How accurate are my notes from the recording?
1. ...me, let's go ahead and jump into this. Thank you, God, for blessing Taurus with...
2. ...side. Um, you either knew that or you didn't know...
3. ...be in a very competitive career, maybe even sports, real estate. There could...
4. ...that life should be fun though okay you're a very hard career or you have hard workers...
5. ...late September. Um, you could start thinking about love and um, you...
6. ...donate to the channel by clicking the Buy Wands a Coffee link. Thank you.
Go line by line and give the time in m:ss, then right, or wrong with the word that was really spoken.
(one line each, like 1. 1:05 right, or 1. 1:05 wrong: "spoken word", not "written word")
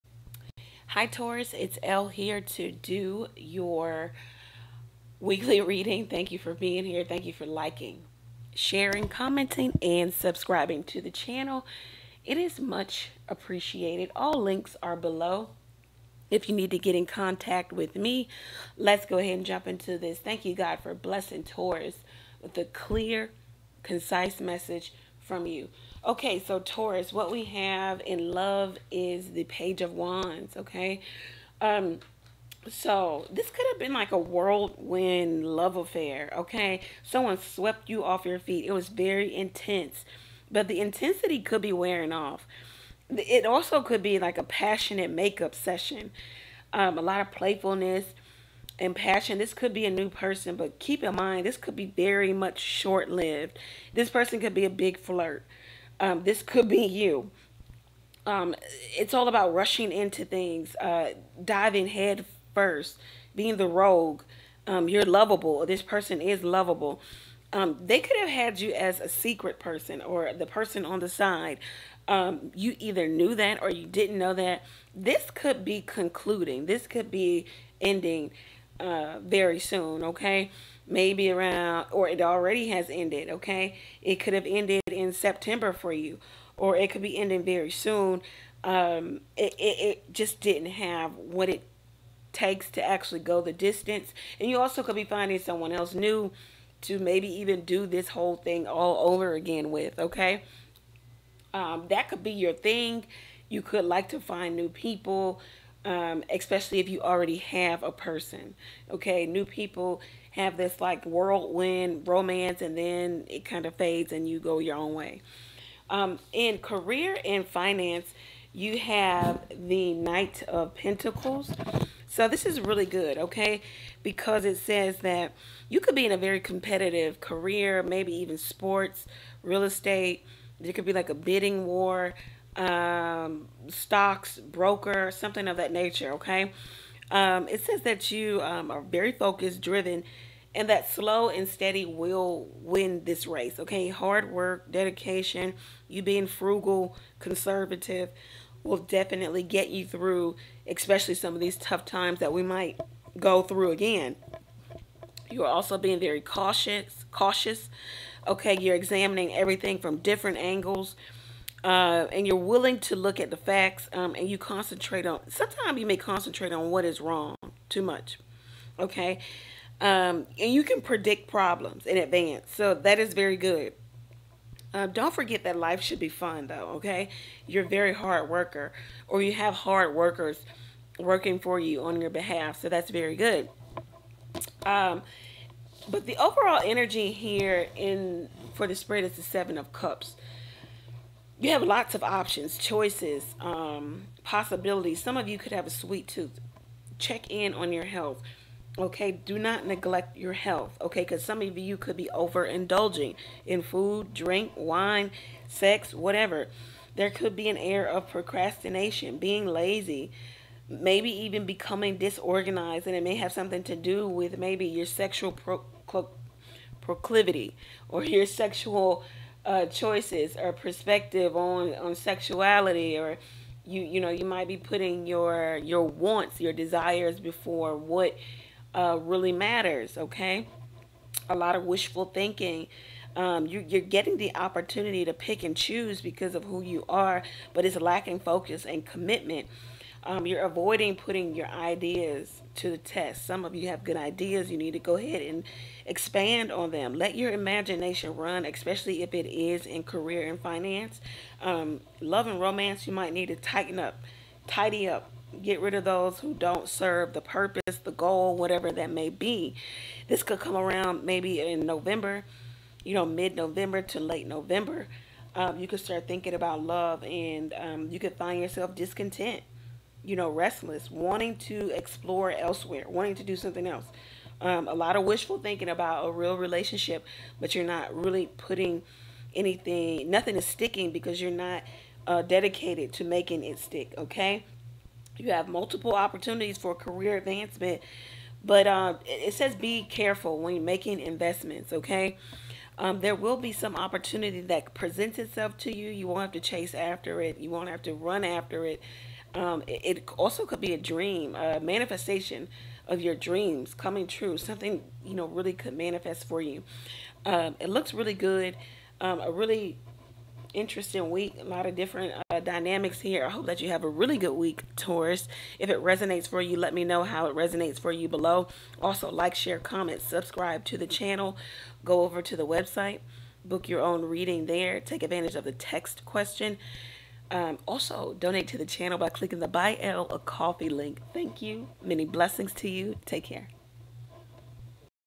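1. 0:17 right
2. 1:11 right
3. 2:05 right
4. 2:55 wrong: "worker", not "career"
5. 4:23 wrong: "November", not "September"
6. 5:28 wrong: "Elle", not "Wands".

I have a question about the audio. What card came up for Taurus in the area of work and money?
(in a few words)
Knight of Pentacles.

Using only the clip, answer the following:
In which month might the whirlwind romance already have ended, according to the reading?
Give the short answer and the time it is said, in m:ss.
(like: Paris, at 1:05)
September, at 1:25.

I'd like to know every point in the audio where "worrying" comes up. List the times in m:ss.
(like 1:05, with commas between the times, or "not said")
not said.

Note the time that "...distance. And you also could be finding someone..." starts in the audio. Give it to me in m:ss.
1:33.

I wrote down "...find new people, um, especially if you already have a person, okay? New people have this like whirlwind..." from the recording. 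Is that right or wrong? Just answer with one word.
right.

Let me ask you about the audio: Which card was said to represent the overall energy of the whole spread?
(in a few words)
Seven of Cups.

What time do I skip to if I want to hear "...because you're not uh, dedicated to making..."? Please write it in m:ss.
4:40.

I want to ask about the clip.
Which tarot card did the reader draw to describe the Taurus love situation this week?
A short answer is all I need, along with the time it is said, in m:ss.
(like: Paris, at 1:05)
Page of Wands, at 0:29.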